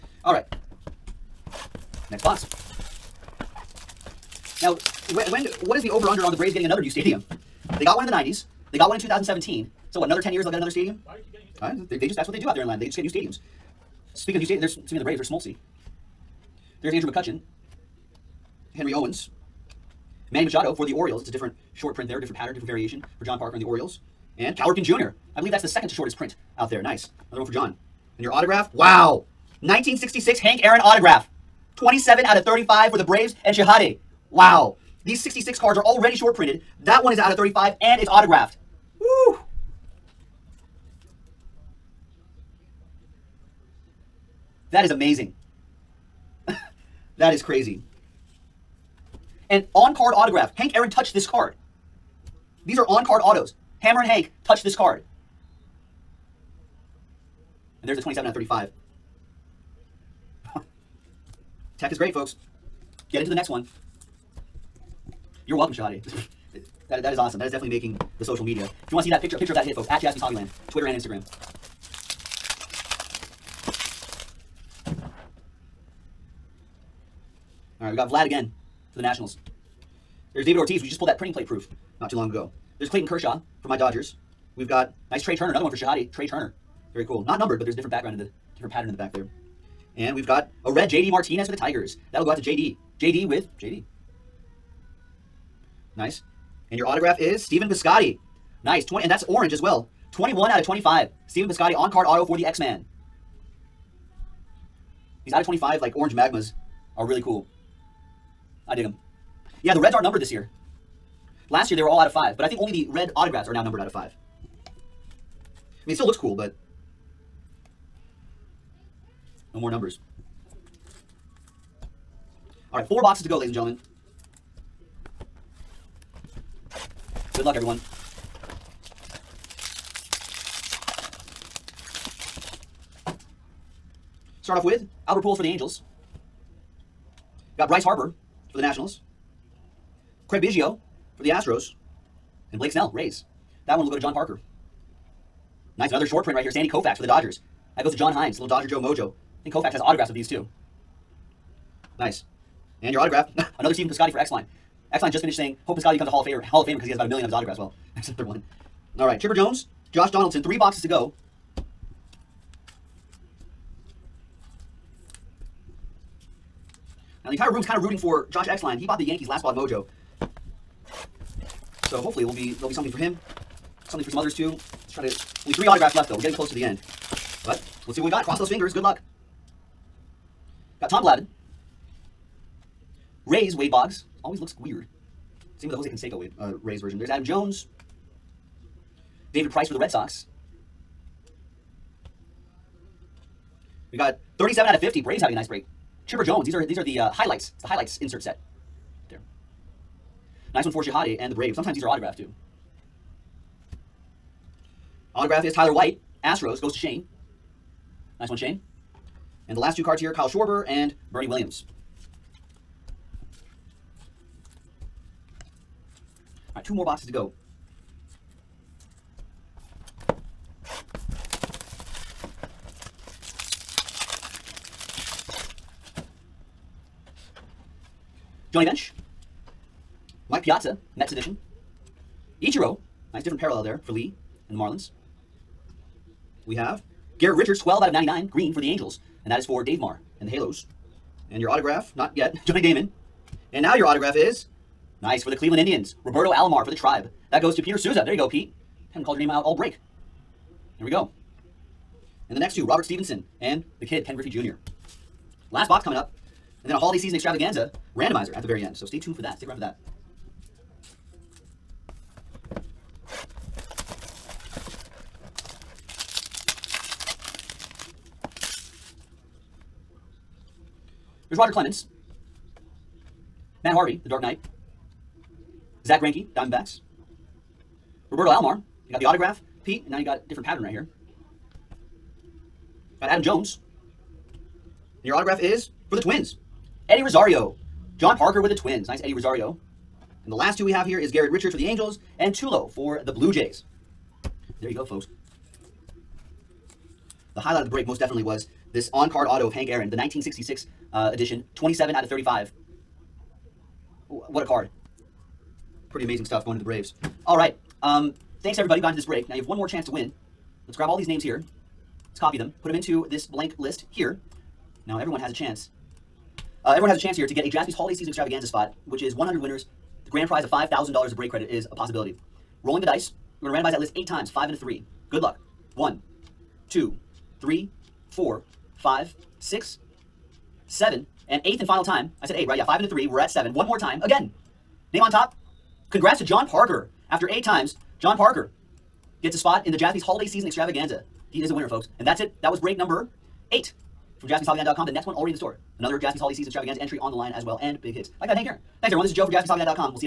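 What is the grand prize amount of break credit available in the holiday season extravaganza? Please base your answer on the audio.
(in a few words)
$5,000.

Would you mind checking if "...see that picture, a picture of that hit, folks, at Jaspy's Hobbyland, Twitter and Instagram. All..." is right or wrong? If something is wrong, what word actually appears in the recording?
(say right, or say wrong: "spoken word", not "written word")
right.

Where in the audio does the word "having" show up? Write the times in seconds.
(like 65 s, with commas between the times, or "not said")
195 s.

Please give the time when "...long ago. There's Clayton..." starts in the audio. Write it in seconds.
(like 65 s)
82 s.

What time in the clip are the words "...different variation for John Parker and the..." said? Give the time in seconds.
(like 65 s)
22 s.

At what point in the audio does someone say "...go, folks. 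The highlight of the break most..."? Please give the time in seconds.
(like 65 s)
294 s.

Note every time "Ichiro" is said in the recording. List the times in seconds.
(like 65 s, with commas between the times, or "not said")
232 s.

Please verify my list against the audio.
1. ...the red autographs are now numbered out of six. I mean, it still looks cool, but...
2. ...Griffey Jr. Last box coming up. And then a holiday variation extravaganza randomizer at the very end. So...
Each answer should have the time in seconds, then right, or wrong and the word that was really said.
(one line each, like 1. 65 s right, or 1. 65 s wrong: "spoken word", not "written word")
1. 112 s wrong: "five", not "six"
2. 254 s wrong: "season", not "variation".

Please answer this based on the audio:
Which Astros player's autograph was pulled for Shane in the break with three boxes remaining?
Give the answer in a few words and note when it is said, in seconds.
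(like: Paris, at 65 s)
Tyler White, at 205 s.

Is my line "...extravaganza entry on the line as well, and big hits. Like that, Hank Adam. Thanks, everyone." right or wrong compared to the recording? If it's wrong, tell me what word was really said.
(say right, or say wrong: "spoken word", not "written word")
wrong: "Aaron", not "Adam".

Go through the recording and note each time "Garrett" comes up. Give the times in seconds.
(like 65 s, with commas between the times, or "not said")
237 s, 291 s.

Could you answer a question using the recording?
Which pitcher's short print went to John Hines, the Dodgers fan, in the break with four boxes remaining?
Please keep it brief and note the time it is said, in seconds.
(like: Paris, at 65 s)
Sandy Koufax, at 146 s.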